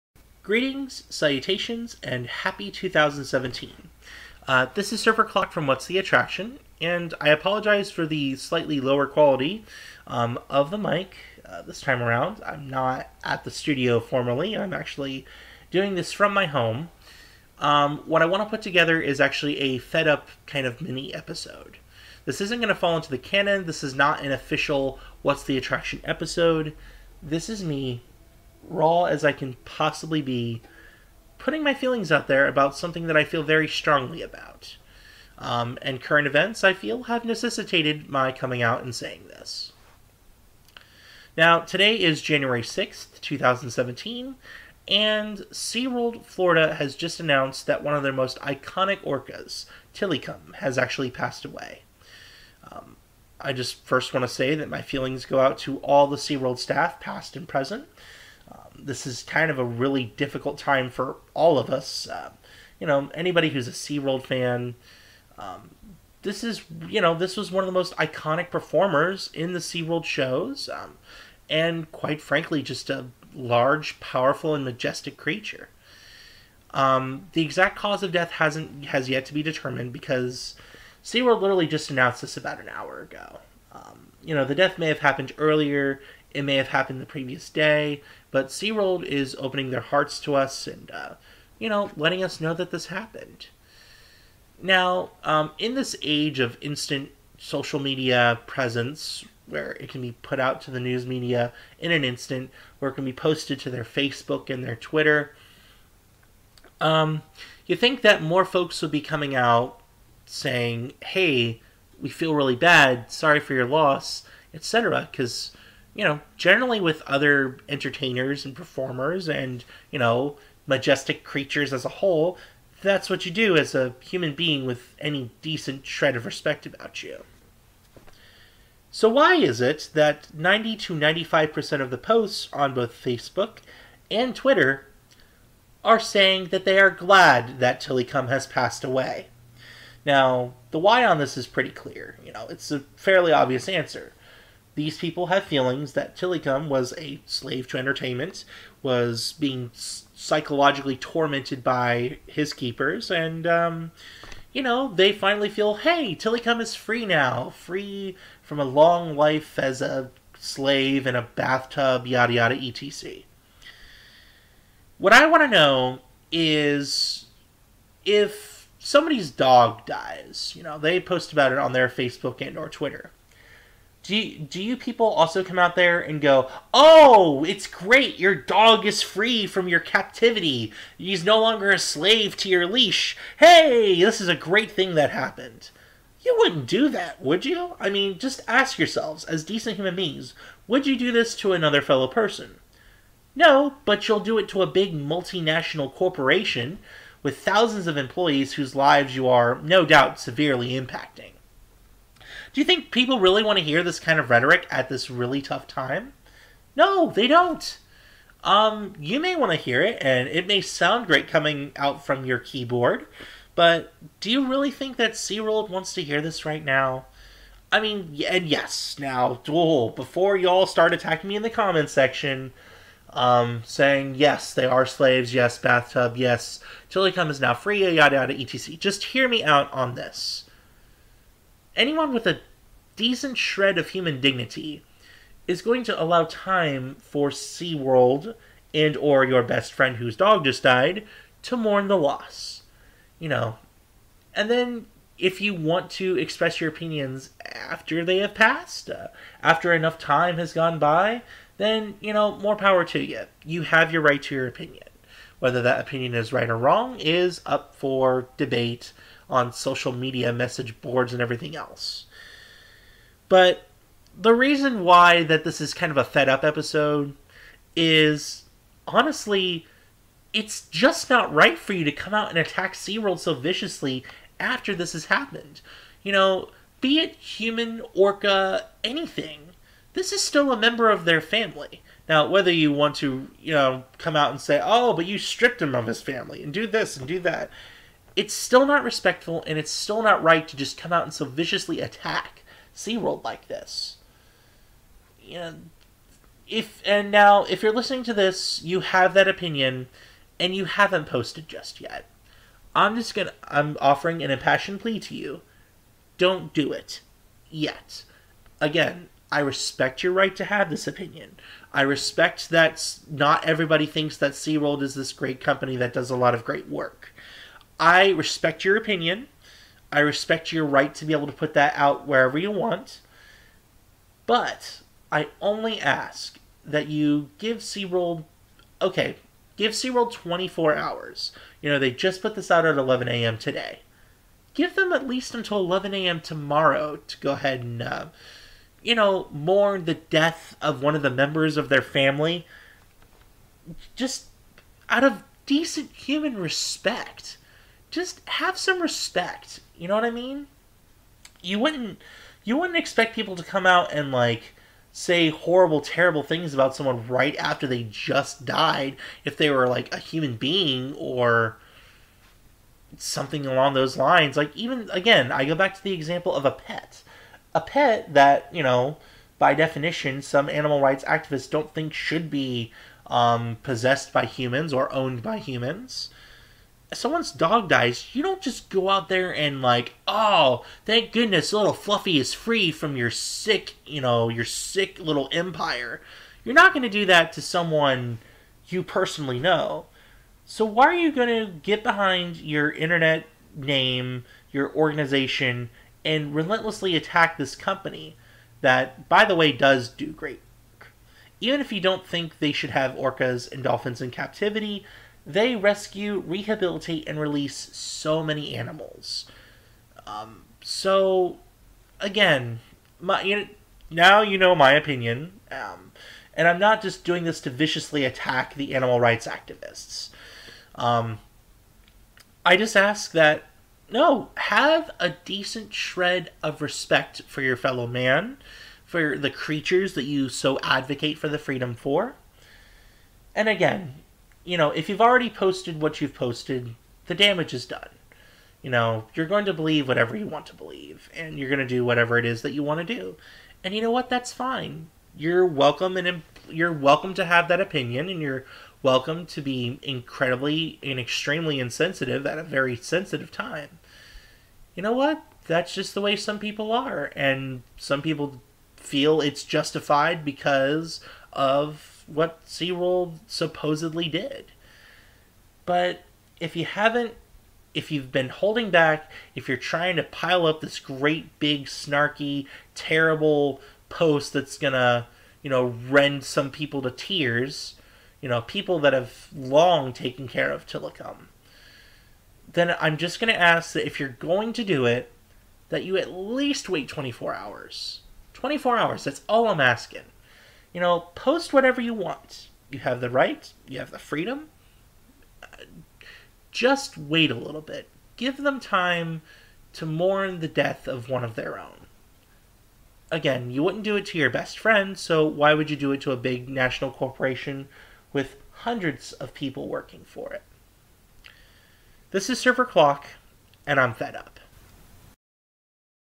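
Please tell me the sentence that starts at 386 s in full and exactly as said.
You're not going to do that to someone you personally know.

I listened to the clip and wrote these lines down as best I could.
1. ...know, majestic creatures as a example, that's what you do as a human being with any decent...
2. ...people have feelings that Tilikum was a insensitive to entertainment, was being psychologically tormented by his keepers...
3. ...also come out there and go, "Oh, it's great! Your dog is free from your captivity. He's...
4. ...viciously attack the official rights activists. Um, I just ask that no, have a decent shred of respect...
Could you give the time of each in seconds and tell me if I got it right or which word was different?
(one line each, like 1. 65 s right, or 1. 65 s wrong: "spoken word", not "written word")
1. 119 s wrong: "whole", not "example"
2. 144 s wrong: "slave", not "insensitive"
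3. 175 s right
4. 417 s wrong: "animal", not "official".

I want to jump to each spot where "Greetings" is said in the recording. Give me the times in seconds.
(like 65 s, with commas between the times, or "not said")
0 s.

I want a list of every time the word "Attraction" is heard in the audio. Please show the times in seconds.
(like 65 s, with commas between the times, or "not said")
5 s, 25 s.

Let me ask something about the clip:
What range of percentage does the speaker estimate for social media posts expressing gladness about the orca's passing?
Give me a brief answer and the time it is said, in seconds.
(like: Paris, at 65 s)
90 to 95%, at 130 s.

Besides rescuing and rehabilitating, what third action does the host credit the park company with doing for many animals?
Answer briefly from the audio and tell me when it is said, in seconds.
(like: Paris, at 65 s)
release, at 407 s.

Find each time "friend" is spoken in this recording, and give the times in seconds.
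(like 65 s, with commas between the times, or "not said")
239 s, 504 s.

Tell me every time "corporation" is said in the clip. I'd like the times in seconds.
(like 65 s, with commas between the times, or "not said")
195 s, 506 s.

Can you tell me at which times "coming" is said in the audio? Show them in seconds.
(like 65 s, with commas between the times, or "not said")
38 s, 109 s, 211 s.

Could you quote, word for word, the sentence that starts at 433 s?
And again, you know, if you've already posted what you've posted, the damage is done.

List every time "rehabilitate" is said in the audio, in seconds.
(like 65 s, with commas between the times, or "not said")
406 s.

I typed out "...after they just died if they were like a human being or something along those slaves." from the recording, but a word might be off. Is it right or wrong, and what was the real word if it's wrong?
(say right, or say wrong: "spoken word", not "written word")
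wrong: "lines", not "slaves".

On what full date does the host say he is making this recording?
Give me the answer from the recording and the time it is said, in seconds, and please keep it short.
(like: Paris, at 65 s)
January 6th, 2017, at 42 s.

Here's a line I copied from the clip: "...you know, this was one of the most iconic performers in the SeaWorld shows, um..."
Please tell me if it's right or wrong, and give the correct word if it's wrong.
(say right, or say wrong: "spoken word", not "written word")
right.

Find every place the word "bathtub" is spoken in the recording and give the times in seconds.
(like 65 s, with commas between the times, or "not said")
161 s, 225 s.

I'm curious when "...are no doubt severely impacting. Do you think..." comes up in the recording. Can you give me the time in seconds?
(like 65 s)
199 s.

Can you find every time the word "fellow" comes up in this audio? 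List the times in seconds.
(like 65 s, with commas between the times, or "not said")
191 s, 427 s.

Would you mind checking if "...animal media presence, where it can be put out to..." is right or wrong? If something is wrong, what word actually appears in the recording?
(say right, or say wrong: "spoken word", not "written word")
wrong: "social", not "animal".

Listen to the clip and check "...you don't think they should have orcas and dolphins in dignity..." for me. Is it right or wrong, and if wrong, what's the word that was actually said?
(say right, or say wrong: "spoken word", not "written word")
wrong: "captivity", not "dignity".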